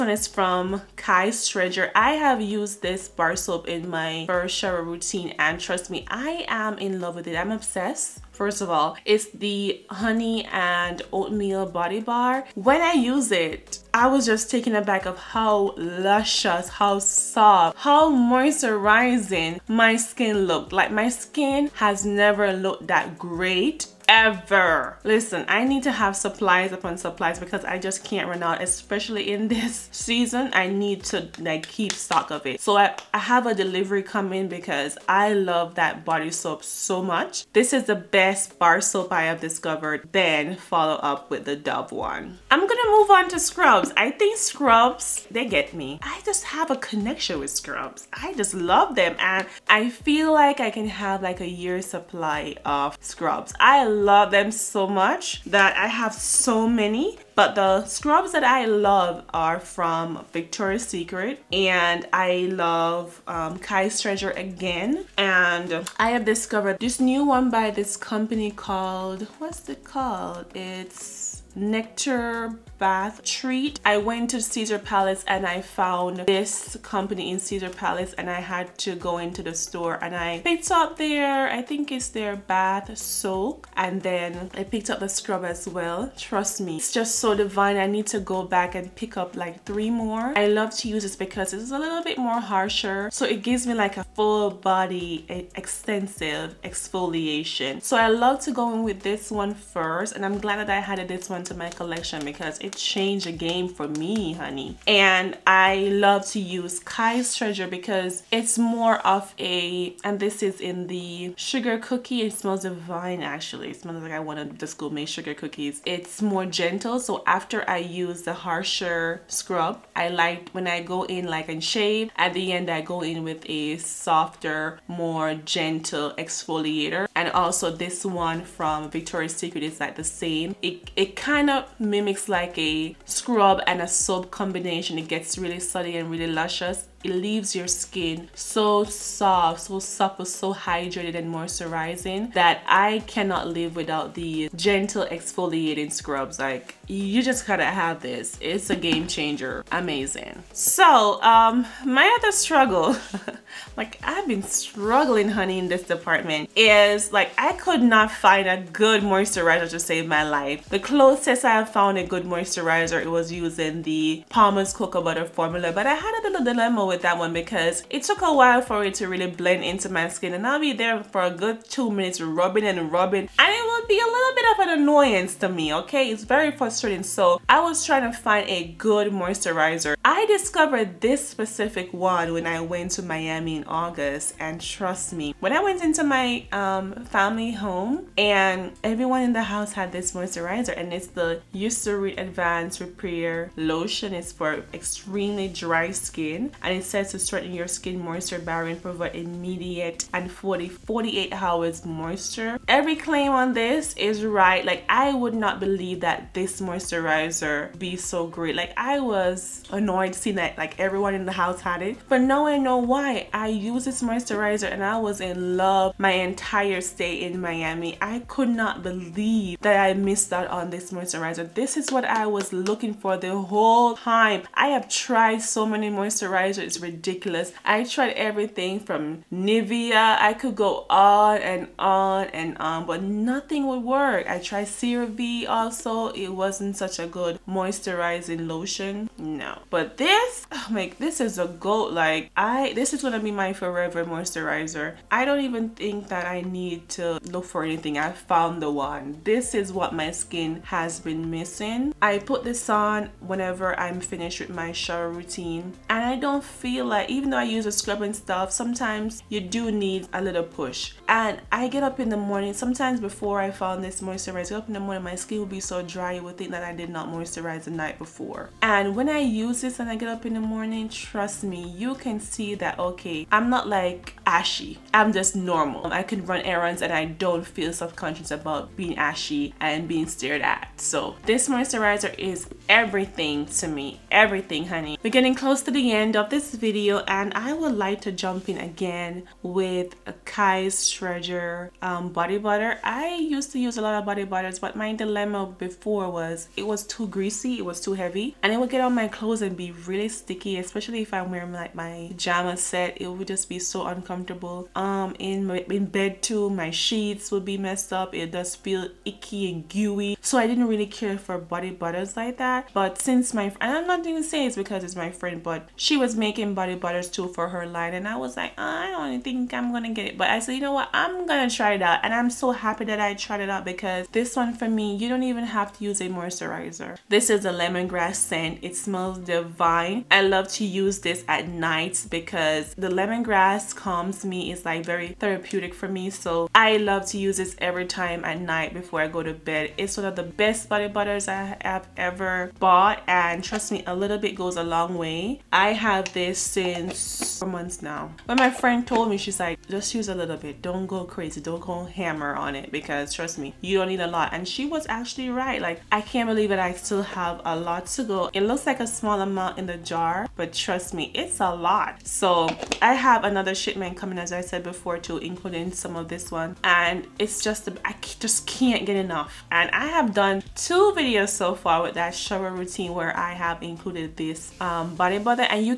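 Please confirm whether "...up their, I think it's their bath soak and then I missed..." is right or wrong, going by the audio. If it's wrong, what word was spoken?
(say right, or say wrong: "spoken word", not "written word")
wrong: "picked", not "missed".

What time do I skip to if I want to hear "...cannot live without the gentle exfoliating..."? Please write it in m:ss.
2:23.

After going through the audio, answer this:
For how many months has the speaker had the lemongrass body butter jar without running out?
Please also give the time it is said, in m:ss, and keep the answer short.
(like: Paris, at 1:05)
4, at 5:47.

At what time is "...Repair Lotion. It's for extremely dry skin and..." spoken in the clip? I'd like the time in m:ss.
3:12.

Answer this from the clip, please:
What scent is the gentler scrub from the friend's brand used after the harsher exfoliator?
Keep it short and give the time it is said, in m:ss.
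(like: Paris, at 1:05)
Sugar cookie, at 1:51.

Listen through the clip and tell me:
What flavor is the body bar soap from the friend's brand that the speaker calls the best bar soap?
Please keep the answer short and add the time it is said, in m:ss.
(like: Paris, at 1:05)
Honey and oatmeal, at 0:09.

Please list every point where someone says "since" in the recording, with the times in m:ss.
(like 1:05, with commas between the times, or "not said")
5:12, 5:46.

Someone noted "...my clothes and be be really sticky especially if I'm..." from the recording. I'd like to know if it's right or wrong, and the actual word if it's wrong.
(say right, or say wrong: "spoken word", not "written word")
right.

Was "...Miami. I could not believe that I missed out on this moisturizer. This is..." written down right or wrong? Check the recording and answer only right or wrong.
right.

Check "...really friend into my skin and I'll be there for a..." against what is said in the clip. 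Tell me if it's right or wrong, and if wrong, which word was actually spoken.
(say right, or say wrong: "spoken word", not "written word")
wrong: "blend", not "friend".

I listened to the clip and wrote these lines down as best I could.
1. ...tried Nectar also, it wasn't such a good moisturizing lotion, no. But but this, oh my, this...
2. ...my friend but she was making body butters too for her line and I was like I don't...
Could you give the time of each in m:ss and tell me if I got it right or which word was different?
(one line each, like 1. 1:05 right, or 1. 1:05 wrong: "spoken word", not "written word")
1. 3:54 wrong: "CeraVe", not "Nectar"
2. 5:14 right.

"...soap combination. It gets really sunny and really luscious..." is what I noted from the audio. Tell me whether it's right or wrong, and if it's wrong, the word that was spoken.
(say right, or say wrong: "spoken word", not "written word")
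right.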